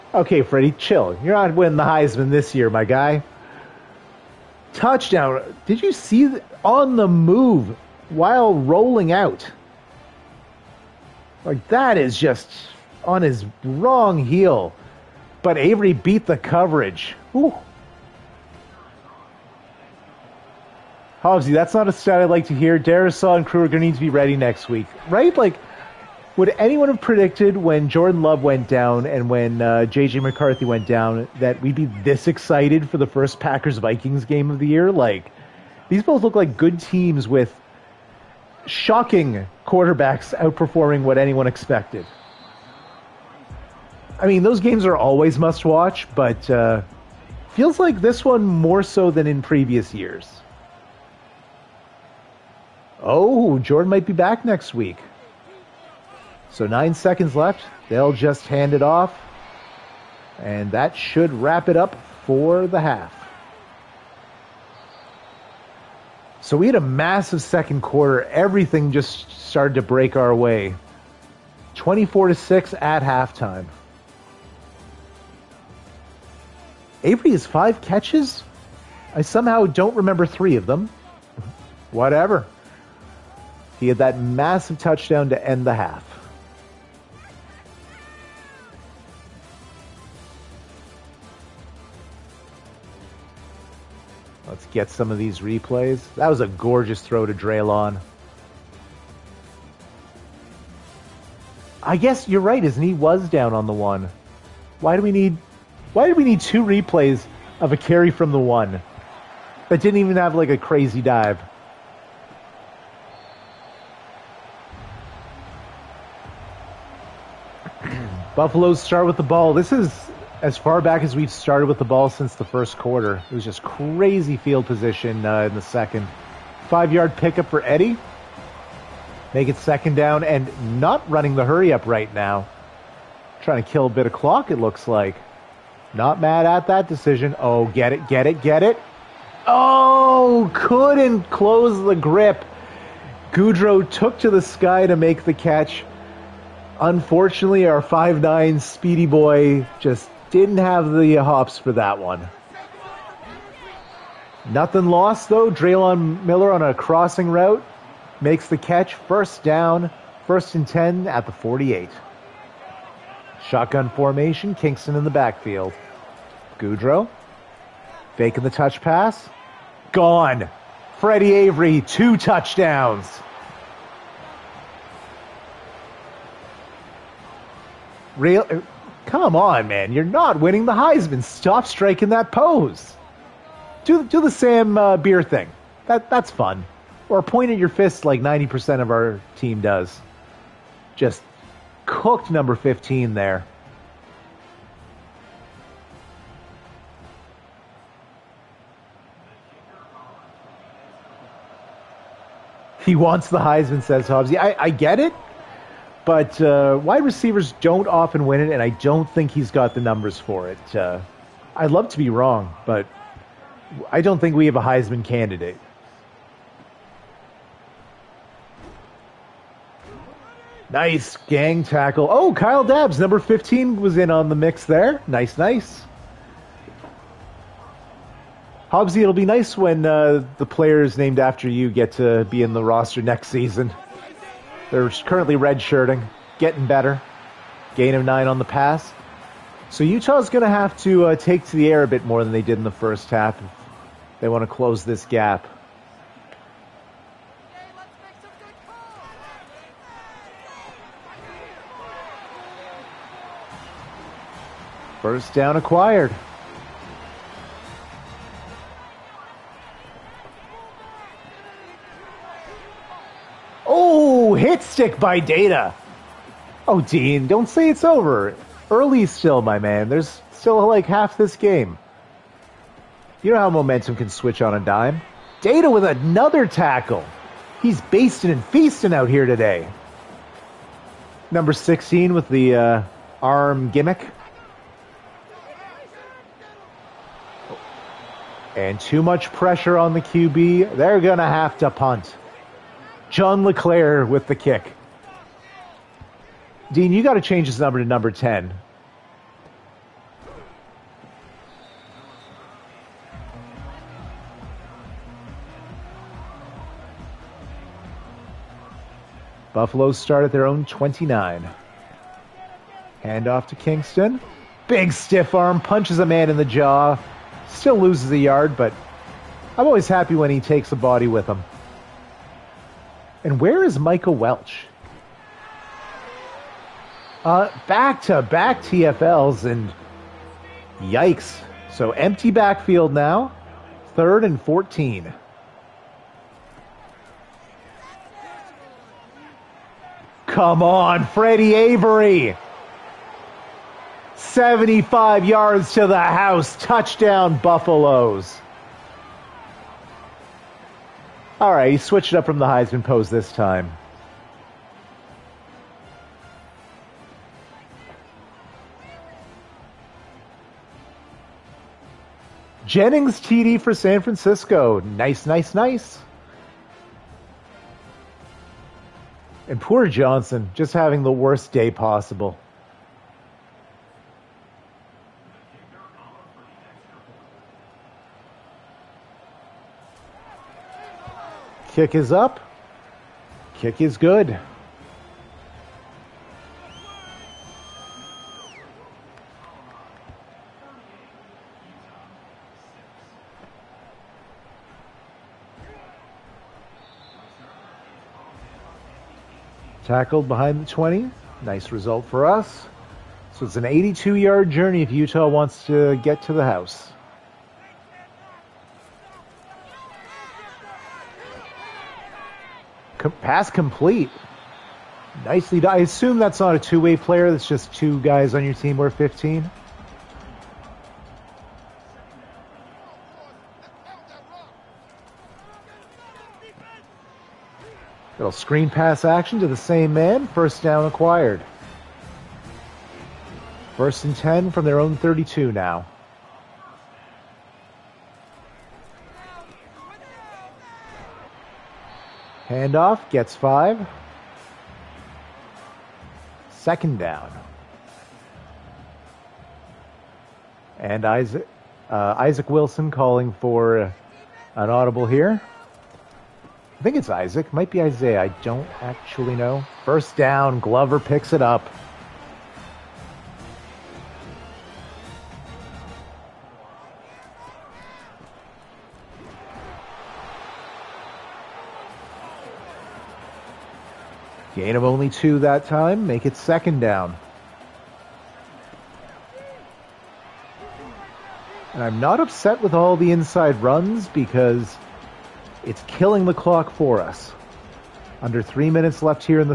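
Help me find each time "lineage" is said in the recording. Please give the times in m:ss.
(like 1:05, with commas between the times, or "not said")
not said.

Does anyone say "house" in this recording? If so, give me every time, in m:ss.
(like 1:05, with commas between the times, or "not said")
5:45, 6:46.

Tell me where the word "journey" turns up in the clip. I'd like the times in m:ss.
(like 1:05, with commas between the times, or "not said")
6:44.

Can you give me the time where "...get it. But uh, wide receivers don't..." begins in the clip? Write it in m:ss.
3:24.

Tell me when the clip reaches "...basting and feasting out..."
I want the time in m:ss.
4:37.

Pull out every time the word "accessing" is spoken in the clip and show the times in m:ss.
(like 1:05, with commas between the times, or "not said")
not said.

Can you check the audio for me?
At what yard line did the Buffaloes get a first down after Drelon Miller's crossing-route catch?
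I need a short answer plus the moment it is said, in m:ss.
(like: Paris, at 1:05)
48, at 2:41.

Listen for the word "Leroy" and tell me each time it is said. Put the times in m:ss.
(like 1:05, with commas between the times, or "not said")
not said.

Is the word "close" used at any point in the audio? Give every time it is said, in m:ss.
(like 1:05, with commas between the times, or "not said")
2:21, 4:04.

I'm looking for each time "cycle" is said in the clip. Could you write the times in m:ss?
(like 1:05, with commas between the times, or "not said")
not said.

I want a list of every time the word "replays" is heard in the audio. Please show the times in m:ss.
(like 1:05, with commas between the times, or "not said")
1:35, 1:46.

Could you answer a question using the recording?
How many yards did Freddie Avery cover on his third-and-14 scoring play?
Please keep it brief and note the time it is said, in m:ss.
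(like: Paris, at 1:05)
75, at 5:44.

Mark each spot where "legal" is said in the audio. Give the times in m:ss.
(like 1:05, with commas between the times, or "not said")
not said.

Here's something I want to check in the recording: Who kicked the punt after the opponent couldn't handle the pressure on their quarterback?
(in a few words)
John LeClair.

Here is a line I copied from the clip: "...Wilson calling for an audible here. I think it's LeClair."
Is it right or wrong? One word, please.
wrong.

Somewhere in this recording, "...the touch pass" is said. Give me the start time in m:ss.
2:48.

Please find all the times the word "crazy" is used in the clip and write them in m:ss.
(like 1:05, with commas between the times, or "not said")
1:50, 2:03.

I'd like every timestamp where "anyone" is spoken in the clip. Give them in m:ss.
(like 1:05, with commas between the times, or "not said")
0:26, 0:41.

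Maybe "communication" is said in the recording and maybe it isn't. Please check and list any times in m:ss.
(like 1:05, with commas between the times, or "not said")
not said.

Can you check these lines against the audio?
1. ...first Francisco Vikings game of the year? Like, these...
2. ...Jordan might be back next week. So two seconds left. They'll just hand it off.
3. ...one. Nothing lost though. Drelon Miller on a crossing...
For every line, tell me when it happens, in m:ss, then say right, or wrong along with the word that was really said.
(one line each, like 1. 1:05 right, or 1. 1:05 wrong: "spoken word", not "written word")
1. 0:33 wrong: "Packers", not "Francisco"
2. 0:53 wrong: "nine", not "two"
3. 2:31 right.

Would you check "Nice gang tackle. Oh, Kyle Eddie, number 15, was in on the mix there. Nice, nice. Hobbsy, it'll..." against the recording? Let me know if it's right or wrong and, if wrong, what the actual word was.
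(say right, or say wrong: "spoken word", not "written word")
wrong: "Dabbs", not "Eddie".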